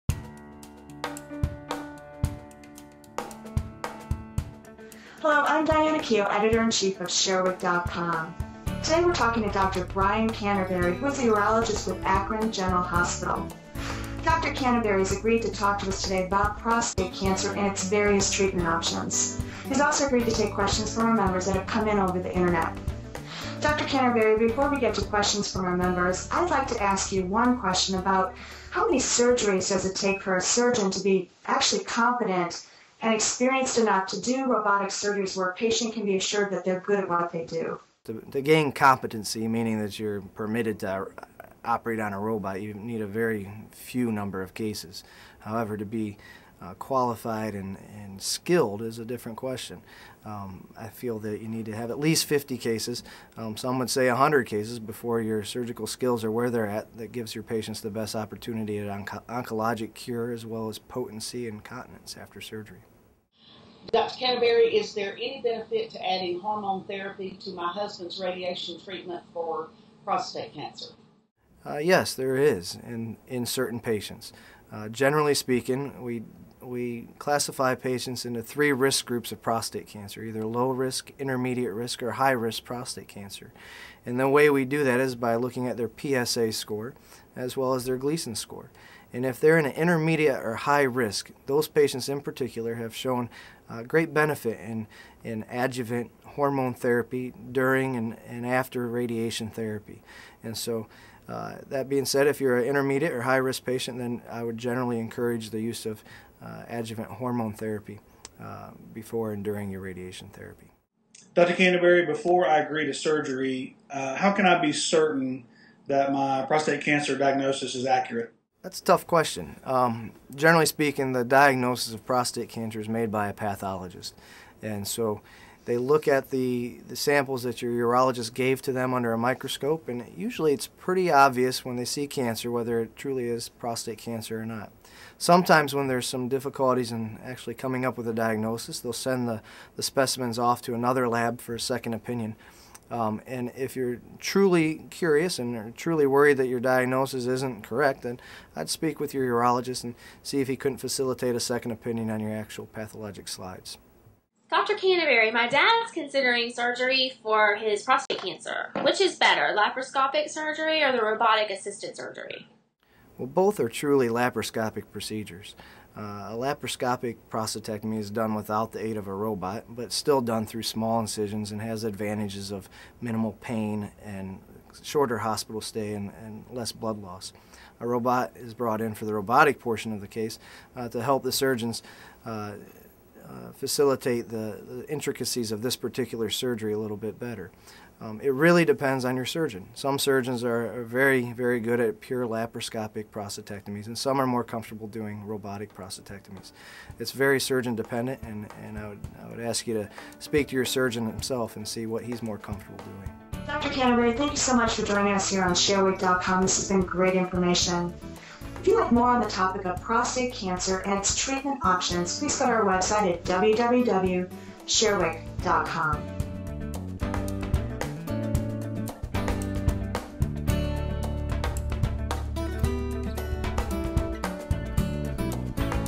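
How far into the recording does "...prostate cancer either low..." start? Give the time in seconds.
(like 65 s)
79 s.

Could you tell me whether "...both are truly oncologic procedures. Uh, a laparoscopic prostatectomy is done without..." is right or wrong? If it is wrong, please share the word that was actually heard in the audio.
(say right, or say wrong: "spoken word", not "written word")
wrong: "laparoscopic", not "oncologic".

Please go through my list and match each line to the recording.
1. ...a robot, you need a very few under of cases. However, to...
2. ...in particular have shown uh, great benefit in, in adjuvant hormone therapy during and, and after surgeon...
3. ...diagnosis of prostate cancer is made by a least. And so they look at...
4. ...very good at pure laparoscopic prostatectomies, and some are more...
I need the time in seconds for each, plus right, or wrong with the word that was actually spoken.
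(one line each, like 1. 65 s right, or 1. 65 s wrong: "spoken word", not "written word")
1. 42 s wrong: "number", not "under"
2. 92 s wrong: "radiation", not "surgeon"
3. 121 s wrong: "pathologist", not "least"
4. 191 s right.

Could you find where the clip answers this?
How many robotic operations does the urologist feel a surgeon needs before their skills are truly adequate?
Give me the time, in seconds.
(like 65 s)
52 s.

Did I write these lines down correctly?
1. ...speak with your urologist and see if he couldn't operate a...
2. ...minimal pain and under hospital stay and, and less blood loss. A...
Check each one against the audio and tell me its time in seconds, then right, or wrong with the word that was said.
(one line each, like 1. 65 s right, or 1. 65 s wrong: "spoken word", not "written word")
1. 148 s wrong: "facilitate", not "operate"
2. 173 s wrong: "shorter", not "under".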